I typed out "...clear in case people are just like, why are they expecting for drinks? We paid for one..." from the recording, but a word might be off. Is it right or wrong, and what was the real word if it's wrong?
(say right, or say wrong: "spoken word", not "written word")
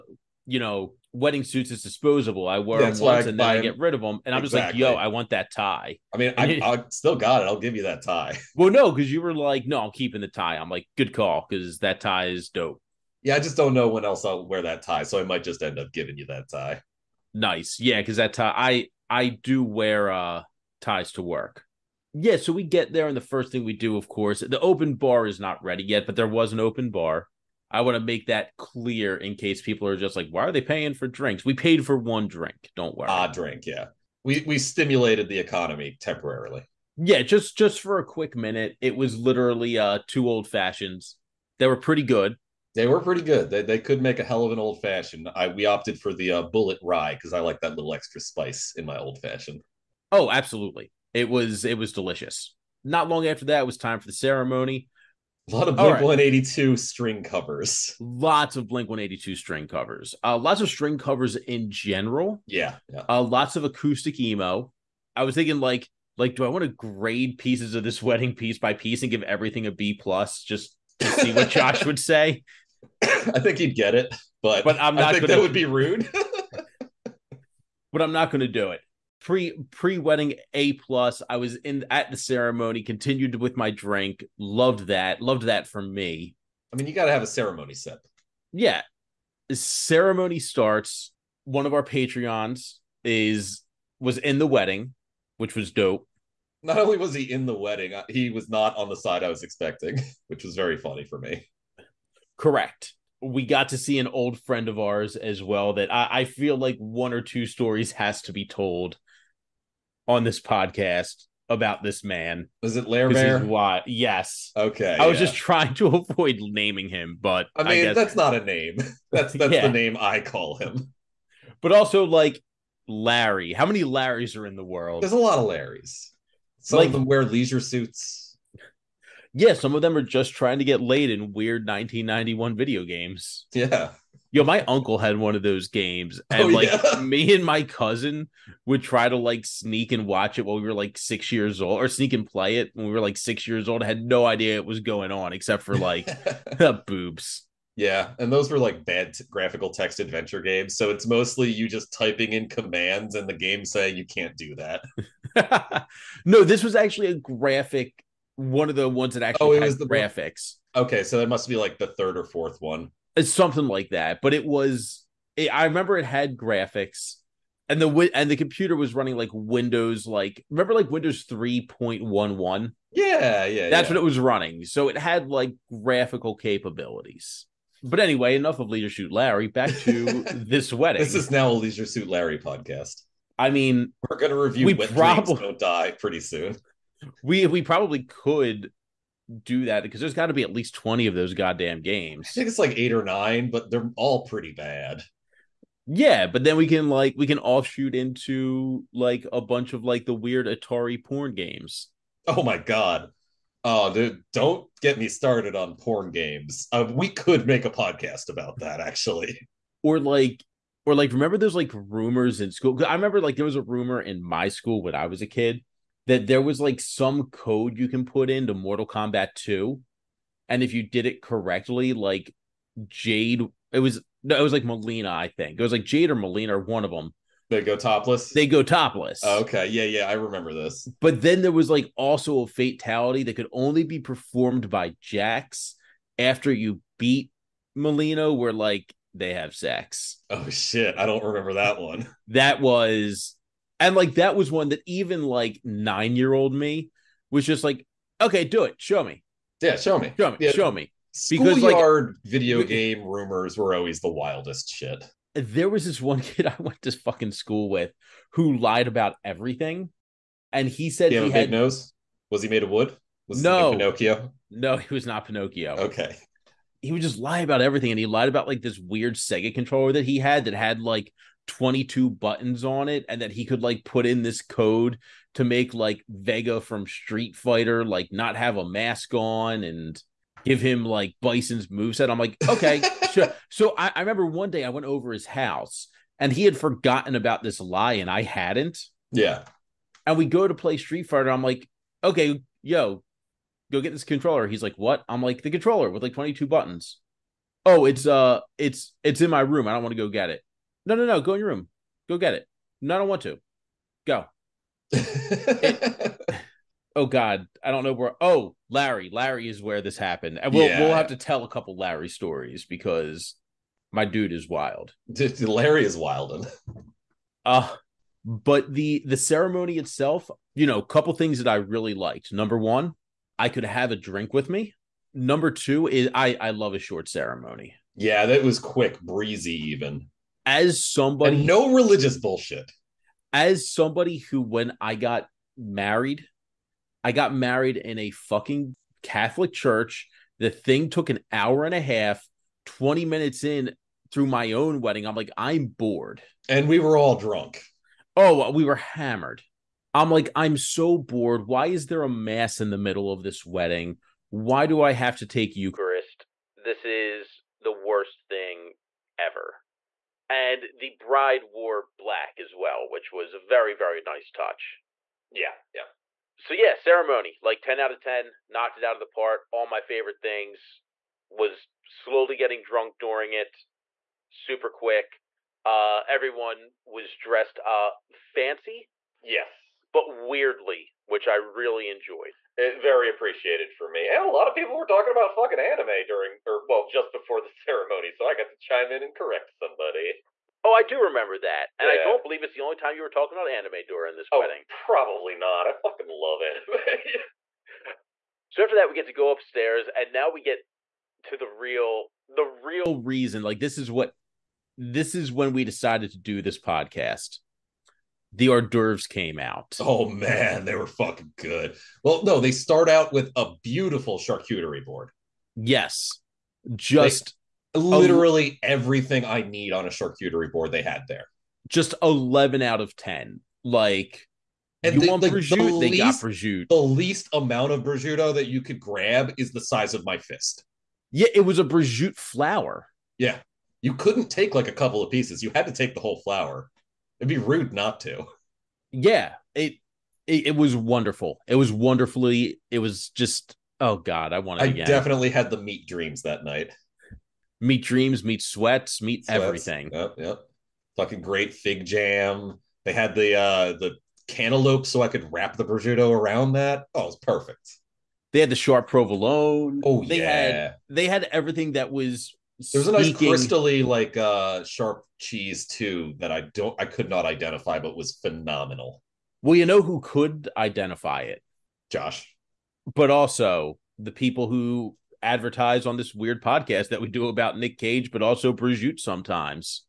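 wrong: "paying", not "expecting".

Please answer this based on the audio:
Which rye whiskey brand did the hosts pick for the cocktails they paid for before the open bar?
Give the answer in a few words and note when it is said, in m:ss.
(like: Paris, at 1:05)
Bulleit, at 0:46.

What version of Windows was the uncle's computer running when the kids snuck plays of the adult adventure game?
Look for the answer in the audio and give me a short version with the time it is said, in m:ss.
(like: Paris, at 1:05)
Windows 3.1, at 2:50.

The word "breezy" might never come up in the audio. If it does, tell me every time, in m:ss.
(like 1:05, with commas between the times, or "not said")
5:28.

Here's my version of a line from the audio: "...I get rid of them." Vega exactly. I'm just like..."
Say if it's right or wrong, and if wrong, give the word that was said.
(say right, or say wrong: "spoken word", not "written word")
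wrong: "And", not "Vega".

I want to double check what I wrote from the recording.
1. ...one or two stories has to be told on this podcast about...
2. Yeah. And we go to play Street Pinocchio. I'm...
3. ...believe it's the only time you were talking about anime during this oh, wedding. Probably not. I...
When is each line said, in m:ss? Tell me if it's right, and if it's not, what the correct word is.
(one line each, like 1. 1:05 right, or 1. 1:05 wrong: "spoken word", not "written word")
1. 1:46 right
2. 4:49 wrong: "Fighter", not "Pinocchio"
3. 6:32 right.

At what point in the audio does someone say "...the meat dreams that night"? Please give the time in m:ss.
7:25.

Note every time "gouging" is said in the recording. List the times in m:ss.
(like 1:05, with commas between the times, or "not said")
not said.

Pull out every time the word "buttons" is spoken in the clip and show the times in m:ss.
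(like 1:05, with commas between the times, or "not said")
4:32, 4:56.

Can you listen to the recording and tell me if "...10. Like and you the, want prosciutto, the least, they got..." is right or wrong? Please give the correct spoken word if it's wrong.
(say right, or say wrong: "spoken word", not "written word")
right.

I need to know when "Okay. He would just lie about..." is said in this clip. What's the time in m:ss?
4:25.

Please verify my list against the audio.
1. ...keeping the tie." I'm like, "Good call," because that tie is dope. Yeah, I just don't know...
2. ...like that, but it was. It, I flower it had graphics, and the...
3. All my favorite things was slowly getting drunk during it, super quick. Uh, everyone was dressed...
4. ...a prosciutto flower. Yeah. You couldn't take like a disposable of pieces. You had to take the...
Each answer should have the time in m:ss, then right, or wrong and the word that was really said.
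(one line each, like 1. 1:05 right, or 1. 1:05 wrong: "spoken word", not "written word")
1. 0:09 right
2. 2:43 wrong: "remember", not "flower"
3. 6:09 right
4. 7:11 wrong: "couple", not "disposable".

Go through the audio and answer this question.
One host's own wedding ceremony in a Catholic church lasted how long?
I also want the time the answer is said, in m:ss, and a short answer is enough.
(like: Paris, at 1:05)
An hour and a half, at 5:41.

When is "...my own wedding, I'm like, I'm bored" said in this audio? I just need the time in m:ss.
5:44.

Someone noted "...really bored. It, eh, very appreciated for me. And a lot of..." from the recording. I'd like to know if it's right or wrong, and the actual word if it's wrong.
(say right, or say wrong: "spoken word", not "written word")
wrong: "enjoyed", not "bored".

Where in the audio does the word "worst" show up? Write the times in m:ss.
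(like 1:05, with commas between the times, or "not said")
5:57.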